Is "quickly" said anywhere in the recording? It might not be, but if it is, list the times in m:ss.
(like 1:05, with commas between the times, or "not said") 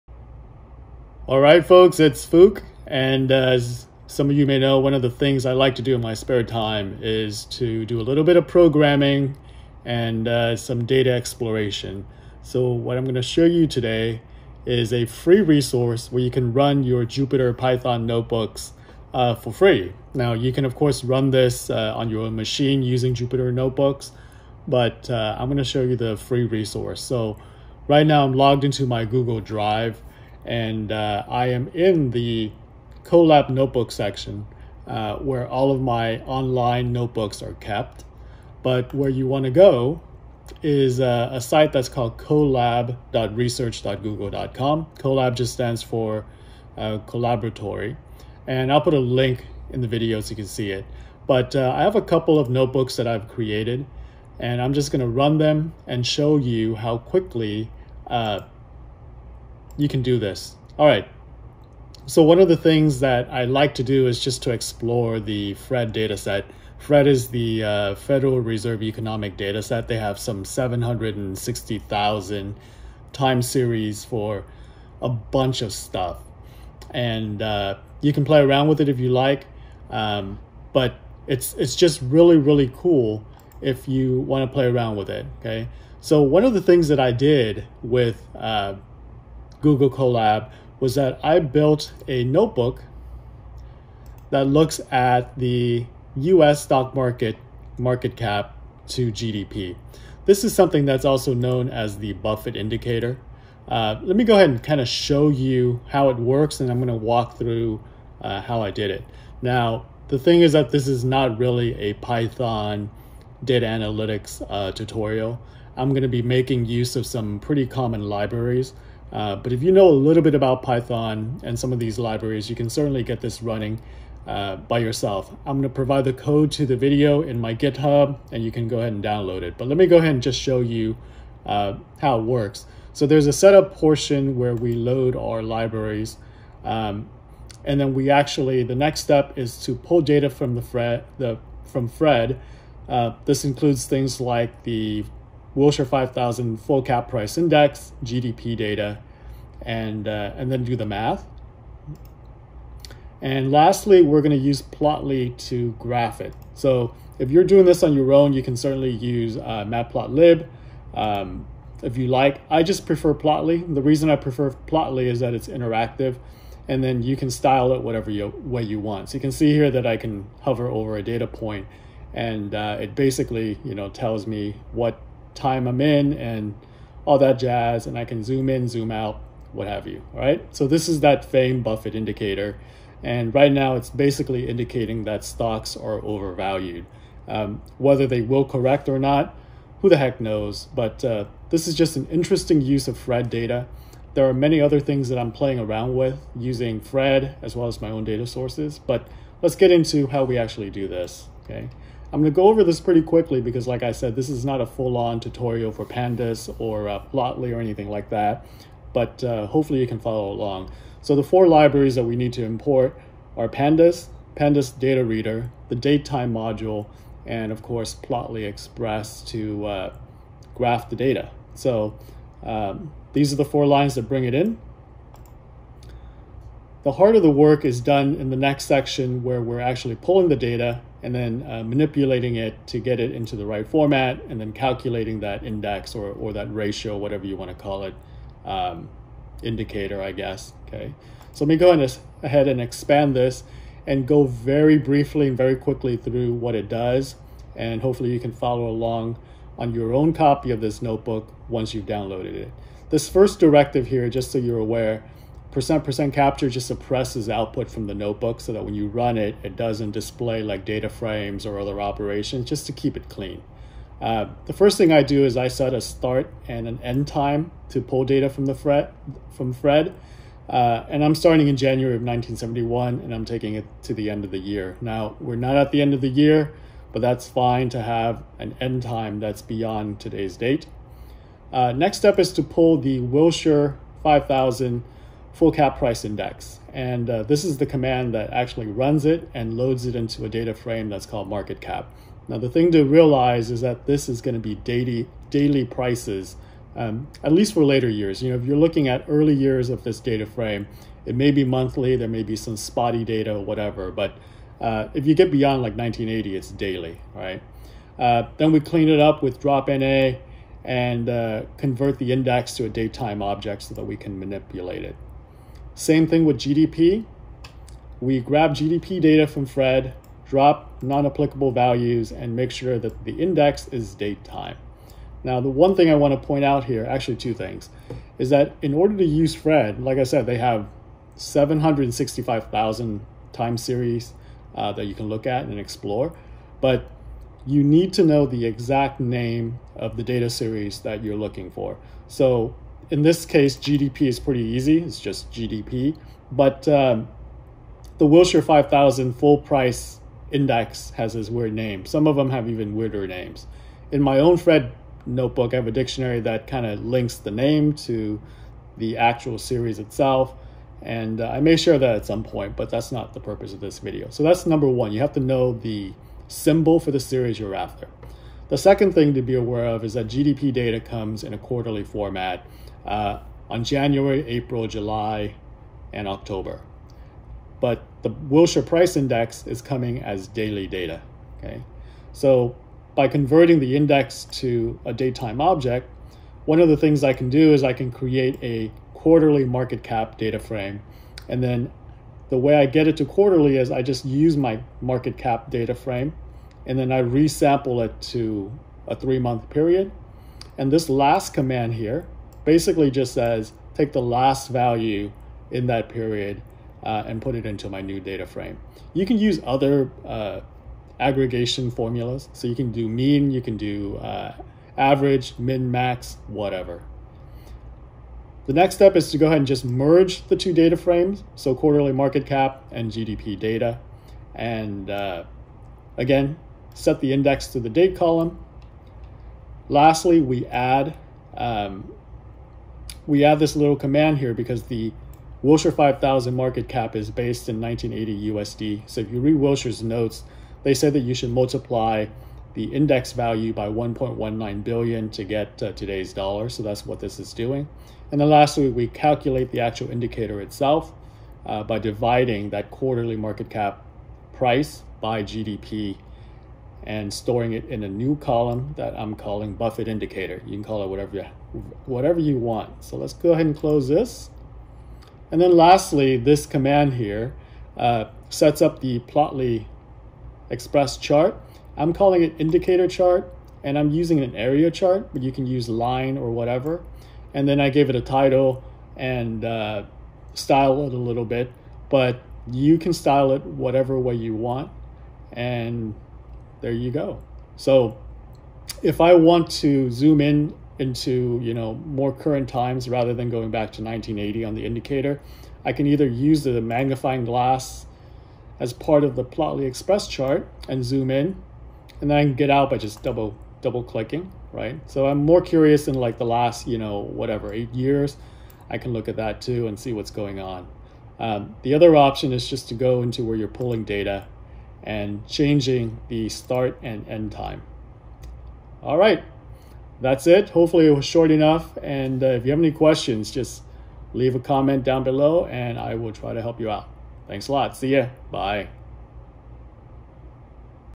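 0:56, 3:23, 4:05.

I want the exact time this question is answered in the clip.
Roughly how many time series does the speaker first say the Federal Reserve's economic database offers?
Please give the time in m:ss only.
1:10.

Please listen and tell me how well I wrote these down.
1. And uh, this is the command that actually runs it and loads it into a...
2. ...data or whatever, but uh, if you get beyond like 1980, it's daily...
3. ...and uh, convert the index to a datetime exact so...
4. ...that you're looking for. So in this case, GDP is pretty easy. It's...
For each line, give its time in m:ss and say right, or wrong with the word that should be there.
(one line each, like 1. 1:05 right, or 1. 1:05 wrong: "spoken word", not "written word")
1. 4:46 right
2. 5:03 right
3. 5:10 wrong: "object", not "exact"
4. 5:40 right.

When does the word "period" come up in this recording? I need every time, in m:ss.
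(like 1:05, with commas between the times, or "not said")
6:39, 6:45.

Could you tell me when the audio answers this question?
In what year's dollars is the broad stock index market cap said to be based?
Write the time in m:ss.
7:17.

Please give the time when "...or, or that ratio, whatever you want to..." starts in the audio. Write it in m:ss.
3:55.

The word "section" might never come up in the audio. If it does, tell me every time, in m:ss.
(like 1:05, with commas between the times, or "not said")
0:33, 3:48.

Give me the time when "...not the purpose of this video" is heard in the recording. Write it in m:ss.
6:02.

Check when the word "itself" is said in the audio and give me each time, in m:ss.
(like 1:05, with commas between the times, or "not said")
5:59, 7:30.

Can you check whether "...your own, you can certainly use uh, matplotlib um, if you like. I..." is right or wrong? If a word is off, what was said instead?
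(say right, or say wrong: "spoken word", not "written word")
right.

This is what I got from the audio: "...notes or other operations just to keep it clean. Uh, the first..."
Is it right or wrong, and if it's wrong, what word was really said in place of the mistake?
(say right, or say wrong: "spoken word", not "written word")
wrong: "frames", not "notes".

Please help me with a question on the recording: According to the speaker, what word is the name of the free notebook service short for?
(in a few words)
collaboratory.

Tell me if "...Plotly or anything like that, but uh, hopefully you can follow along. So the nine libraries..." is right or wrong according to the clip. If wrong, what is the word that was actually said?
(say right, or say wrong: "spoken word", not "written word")
wrong: "four", not "nine".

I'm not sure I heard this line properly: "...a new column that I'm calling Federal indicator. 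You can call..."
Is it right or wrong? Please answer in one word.
wrong.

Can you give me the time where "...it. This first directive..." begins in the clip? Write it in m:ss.
4:12.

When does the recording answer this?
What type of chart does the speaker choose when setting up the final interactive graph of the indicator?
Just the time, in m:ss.
7:54.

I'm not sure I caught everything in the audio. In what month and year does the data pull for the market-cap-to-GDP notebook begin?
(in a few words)
January 1971.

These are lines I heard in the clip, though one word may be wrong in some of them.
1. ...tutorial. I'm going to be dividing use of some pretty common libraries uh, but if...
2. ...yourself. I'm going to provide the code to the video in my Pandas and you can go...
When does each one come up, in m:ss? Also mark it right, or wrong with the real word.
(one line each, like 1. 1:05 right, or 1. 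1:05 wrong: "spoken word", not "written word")
1. 1:54 wrong: "making", not "dividing"
2. 2:04 wrong: "GitHub", not "Pandas".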